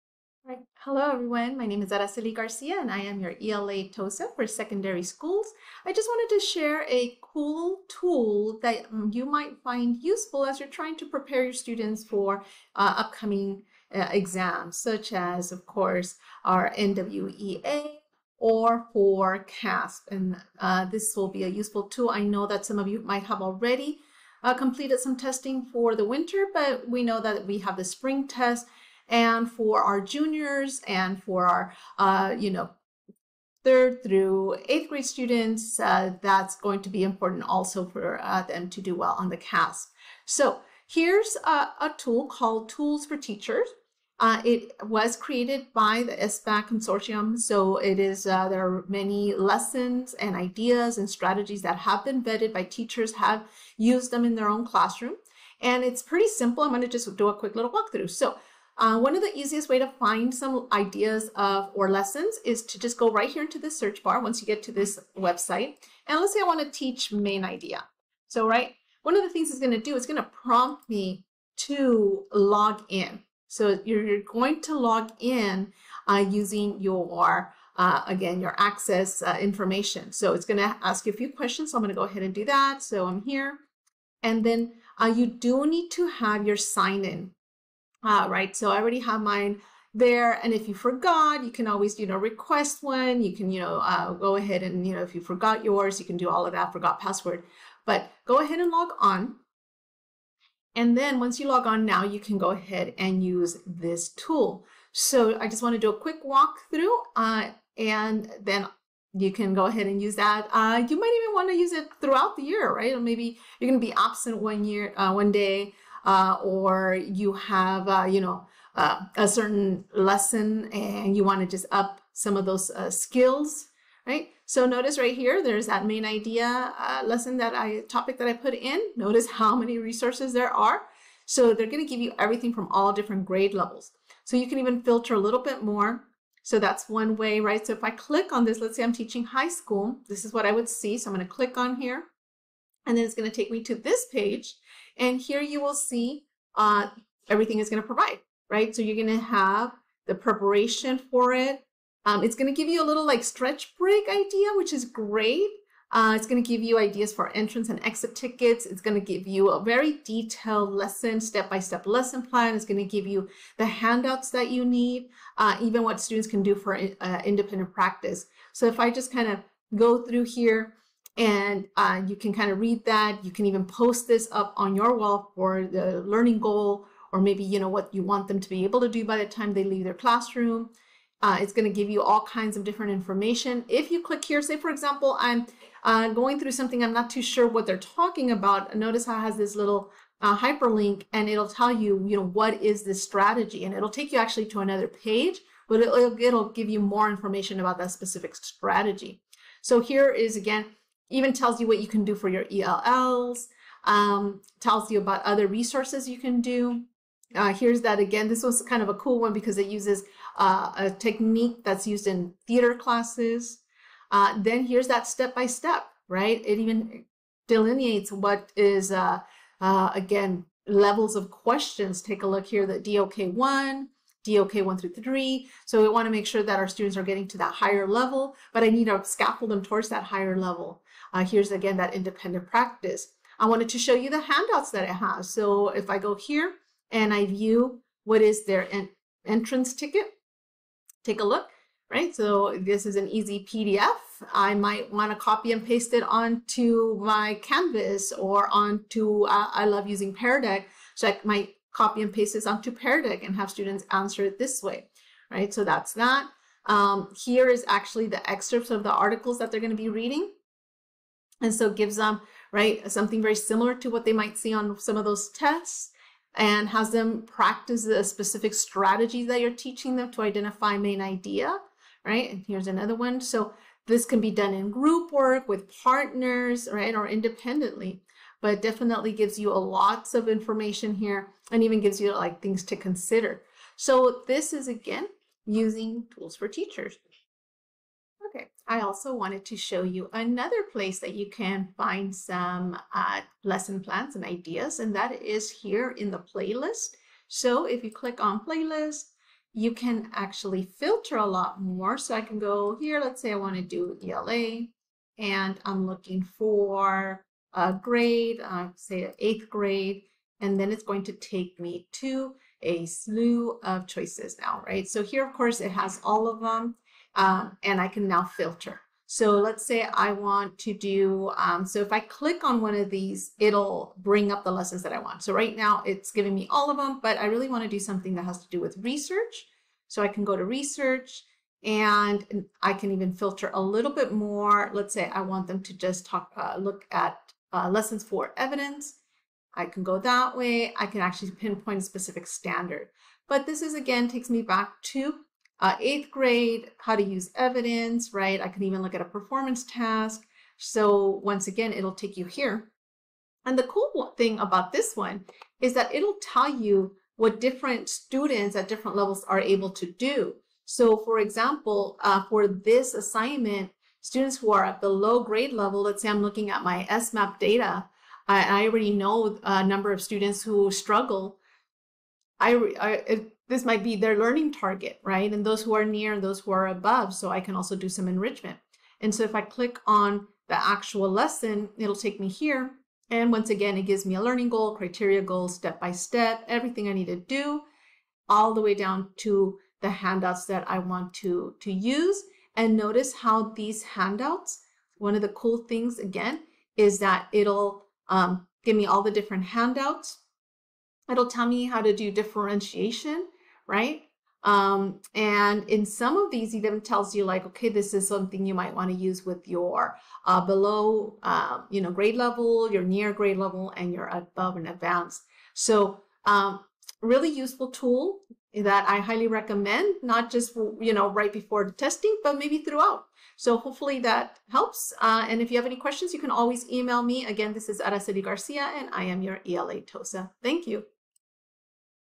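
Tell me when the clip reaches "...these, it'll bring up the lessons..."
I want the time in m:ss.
5:22.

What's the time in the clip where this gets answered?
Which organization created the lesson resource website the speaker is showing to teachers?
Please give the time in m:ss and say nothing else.
0:46.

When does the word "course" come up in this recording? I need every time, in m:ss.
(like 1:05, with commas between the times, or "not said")
0:15, 5:15.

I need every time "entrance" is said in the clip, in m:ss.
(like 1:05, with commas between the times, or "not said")
2:37, 3:59.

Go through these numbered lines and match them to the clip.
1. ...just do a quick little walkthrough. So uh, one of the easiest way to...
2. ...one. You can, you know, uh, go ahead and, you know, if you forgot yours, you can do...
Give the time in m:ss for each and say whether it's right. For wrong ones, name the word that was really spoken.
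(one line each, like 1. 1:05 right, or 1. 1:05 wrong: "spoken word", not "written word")
1. 0:56 right
2. 1:32 right.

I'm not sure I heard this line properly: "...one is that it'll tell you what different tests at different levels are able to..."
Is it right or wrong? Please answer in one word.
wrong.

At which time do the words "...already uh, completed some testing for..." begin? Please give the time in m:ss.
0:23.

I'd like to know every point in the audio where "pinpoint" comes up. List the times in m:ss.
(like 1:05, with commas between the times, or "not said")
5:41.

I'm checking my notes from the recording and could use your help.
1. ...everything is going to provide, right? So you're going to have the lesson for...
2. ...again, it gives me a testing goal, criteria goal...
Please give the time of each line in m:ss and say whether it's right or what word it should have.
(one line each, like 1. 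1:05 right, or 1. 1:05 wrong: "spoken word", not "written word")
1. 2:27 wrong: "preparation", not "lesson"
2. 6:23 wrong: "learning", not "testing".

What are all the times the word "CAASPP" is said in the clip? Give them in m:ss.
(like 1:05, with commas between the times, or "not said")
0:19, 0:39.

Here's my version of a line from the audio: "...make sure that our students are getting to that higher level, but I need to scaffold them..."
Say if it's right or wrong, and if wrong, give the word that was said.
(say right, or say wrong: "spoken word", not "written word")
right.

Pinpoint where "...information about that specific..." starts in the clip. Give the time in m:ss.
3:17.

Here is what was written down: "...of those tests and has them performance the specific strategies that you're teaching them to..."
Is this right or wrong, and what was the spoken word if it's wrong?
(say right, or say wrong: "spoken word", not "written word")
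wrong: "practice", not "performance".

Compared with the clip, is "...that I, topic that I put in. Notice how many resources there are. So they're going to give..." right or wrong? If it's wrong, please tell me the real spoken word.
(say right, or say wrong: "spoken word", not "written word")
right.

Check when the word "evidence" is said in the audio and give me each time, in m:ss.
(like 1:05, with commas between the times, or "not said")
5:38, 5:47.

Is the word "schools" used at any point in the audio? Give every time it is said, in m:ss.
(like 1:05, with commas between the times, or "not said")
0:05, 2:19.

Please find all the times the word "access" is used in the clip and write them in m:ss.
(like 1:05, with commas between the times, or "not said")
1:18.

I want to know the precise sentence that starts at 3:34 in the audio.
Uh, then here's that step by step, right?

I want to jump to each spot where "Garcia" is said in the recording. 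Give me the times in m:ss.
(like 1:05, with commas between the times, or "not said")
0:02, 7:08.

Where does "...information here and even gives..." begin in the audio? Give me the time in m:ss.
4:40.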